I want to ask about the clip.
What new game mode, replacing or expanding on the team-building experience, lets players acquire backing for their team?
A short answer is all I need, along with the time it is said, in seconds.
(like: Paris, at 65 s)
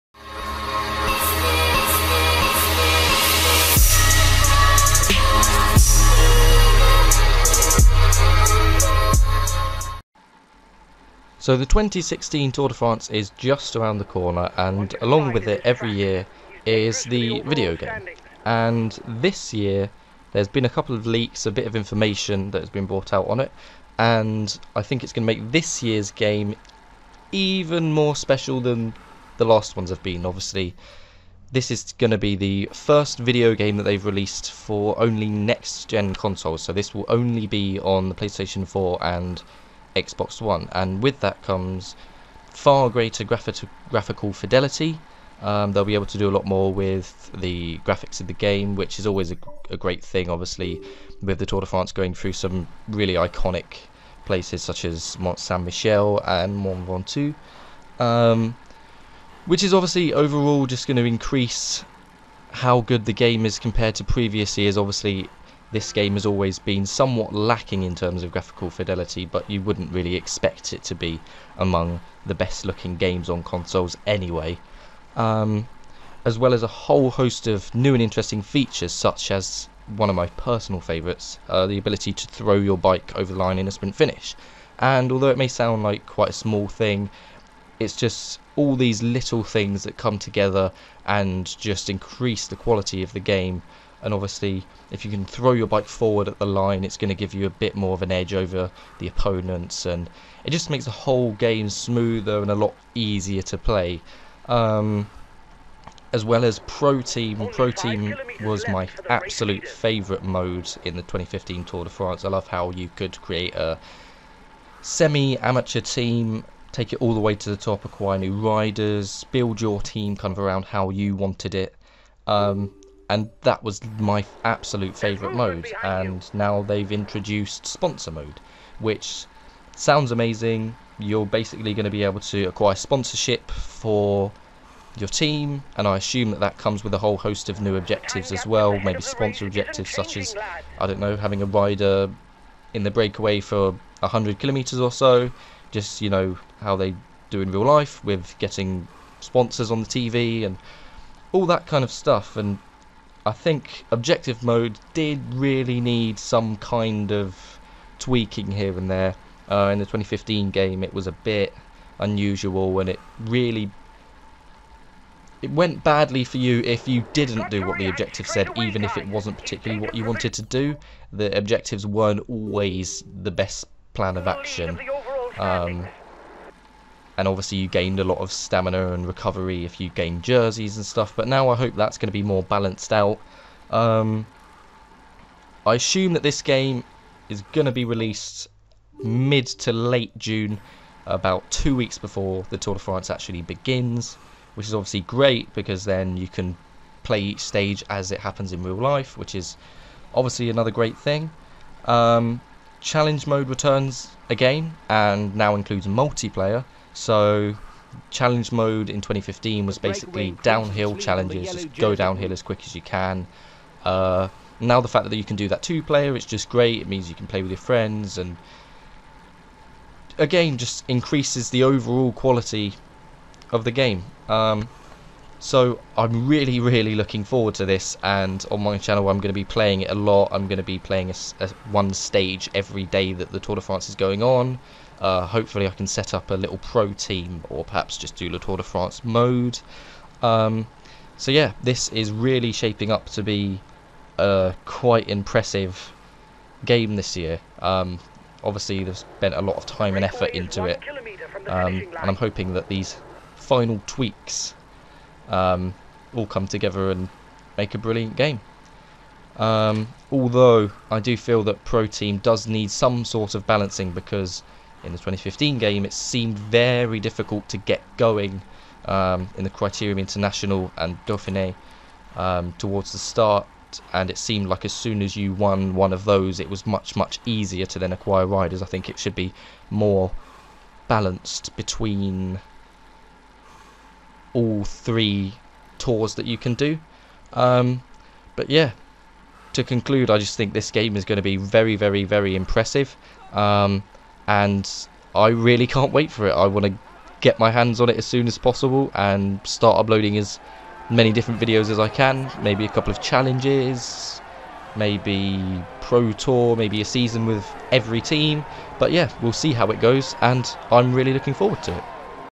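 Sponsor mode, at 127 s.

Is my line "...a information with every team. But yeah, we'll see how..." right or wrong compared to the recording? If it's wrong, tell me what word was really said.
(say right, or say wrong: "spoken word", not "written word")
wrong: "season", not "information".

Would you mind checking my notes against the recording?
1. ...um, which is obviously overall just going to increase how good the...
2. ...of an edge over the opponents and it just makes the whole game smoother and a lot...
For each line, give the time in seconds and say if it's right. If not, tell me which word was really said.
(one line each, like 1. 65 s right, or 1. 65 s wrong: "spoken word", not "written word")
1. 57 s right
2. 97 s right.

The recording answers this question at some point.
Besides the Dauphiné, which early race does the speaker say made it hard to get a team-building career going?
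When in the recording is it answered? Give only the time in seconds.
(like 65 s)
269 s.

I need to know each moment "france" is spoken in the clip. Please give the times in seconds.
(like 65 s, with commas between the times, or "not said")
12 s, 51 s, 111 s, 192 s, 233 s, 238 s.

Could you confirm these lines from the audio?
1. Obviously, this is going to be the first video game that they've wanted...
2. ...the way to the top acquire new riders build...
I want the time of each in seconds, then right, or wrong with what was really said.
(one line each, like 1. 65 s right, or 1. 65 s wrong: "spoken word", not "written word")
1. 30 s wrong: "released", not "wanted"
2. 117 s right.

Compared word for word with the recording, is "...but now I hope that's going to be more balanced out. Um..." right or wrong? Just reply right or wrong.
right.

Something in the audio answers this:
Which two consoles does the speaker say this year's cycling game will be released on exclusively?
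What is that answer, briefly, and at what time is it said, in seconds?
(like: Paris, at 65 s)
PlayStation 4 and Xbox One, at 38 s.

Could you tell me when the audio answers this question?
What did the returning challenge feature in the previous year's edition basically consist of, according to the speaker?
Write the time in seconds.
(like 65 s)
210 s.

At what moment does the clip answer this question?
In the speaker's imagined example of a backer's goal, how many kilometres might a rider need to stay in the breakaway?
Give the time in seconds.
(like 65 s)
143 s.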